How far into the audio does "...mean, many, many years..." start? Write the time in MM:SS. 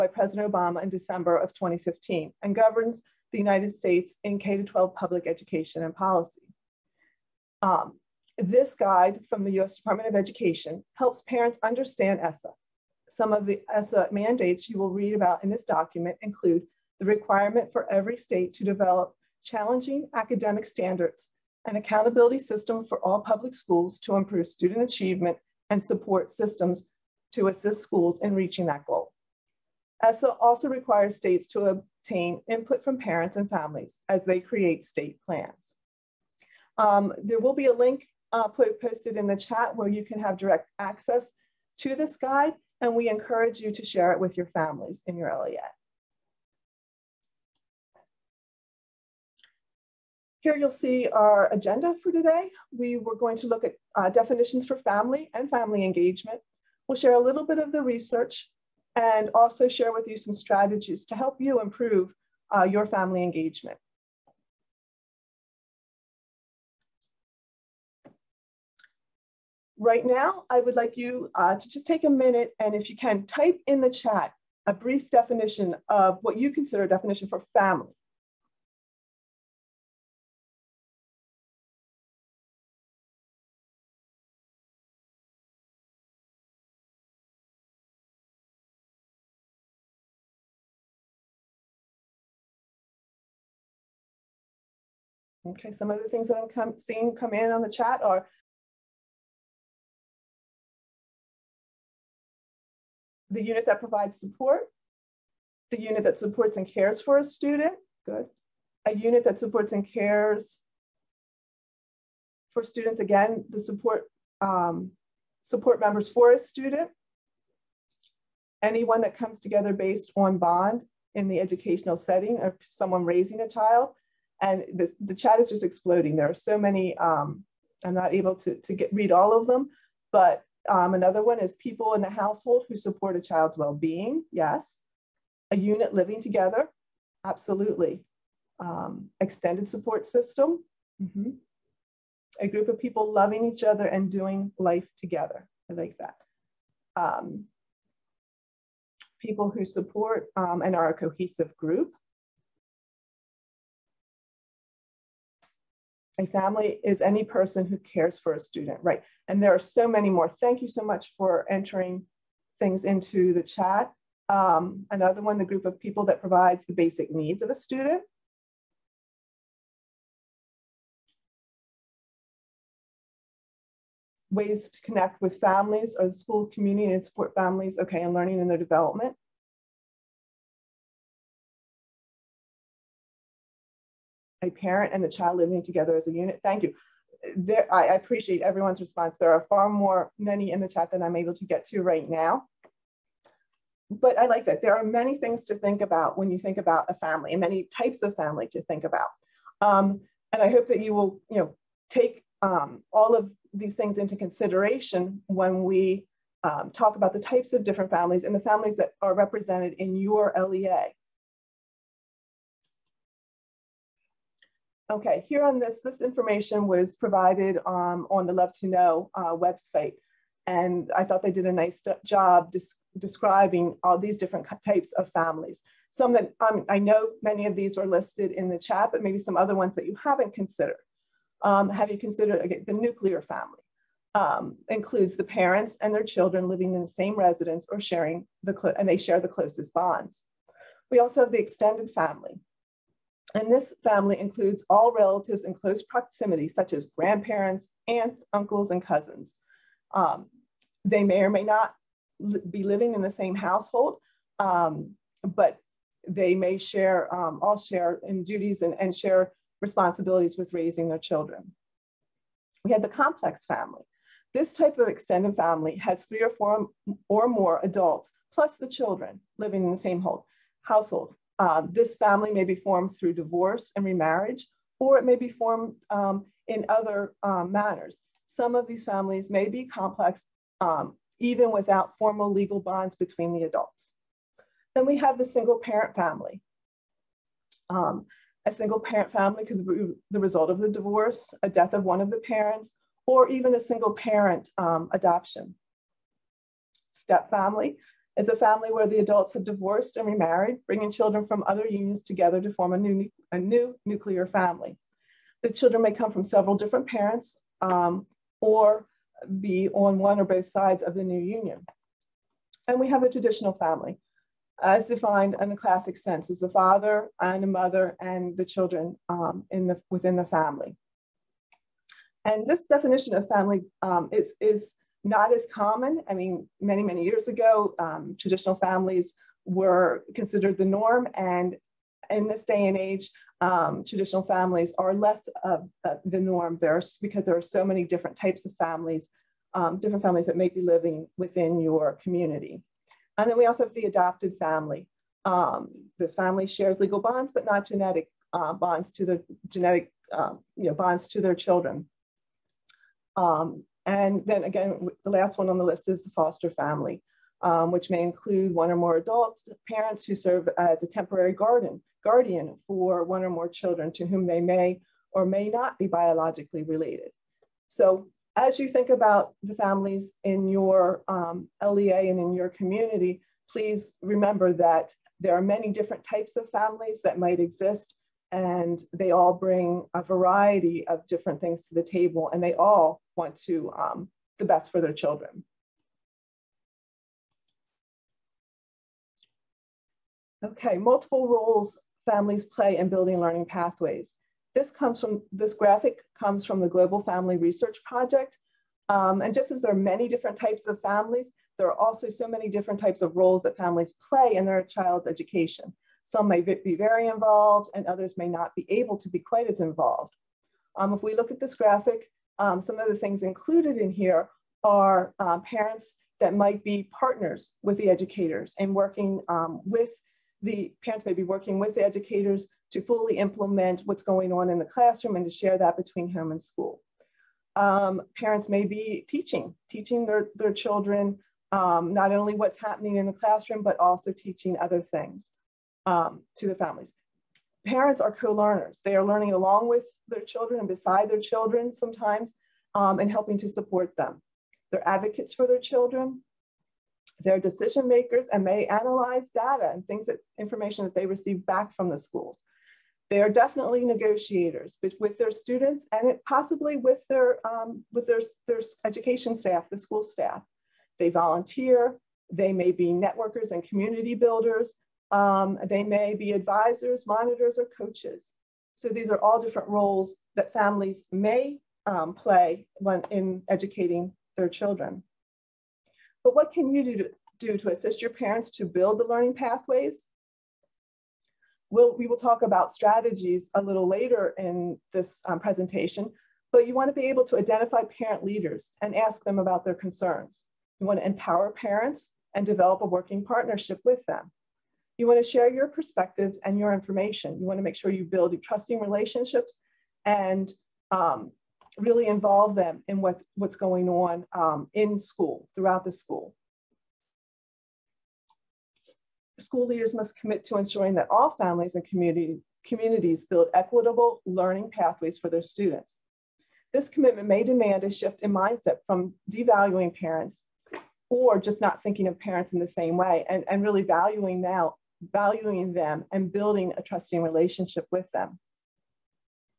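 05:26.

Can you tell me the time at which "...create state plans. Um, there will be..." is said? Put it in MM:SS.
00:34.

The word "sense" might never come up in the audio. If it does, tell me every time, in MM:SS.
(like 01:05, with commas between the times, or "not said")
05:15.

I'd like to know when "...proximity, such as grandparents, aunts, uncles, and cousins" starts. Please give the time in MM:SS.
04:05.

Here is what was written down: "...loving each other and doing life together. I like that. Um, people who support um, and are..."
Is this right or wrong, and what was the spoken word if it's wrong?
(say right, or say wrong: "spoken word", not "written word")
right.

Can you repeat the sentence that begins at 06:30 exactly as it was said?
Okay, multiple roles families play in building learning pathways.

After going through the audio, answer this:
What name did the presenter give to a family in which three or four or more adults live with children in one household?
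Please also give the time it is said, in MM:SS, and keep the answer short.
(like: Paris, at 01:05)
Complex family, at 04:23.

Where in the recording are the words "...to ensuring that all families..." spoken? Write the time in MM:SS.
08:30.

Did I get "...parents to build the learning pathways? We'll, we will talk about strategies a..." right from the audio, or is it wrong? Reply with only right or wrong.
right.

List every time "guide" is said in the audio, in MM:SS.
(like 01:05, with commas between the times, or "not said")
00:08, 00:42.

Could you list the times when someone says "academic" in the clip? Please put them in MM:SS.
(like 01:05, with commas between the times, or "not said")
00:20.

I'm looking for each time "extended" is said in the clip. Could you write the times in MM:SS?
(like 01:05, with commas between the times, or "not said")
02:19, 04:01, 04:24.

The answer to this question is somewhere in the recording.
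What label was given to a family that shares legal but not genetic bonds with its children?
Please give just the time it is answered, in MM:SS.
05:43.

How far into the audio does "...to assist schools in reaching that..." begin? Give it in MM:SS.
00:27.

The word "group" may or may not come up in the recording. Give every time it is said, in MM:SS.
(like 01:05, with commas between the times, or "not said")
02:22, 02:31, 02:45.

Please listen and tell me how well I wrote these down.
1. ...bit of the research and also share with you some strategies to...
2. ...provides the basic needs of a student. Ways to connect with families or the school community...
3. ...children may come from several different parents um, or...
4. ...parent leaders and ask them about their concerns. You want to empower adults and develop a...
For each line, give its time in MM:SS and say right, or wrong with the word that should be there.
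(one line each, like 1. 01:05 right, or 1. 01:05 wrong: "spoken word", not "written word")
1. 00:57 right
2. 02:46 right
3. 05:05 right
4. 08:07 wrong: "parents", not "adults".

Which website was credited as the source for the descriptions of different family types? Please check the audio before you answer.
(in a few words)
Love to Know.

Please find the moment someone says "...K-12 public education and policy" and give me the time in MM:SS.
00:04.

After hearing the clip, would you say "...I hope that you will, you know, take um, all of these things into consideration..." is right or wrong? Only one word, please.
right.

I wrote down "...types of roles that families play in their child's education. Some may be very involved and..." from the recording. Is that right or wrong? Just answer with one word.
right.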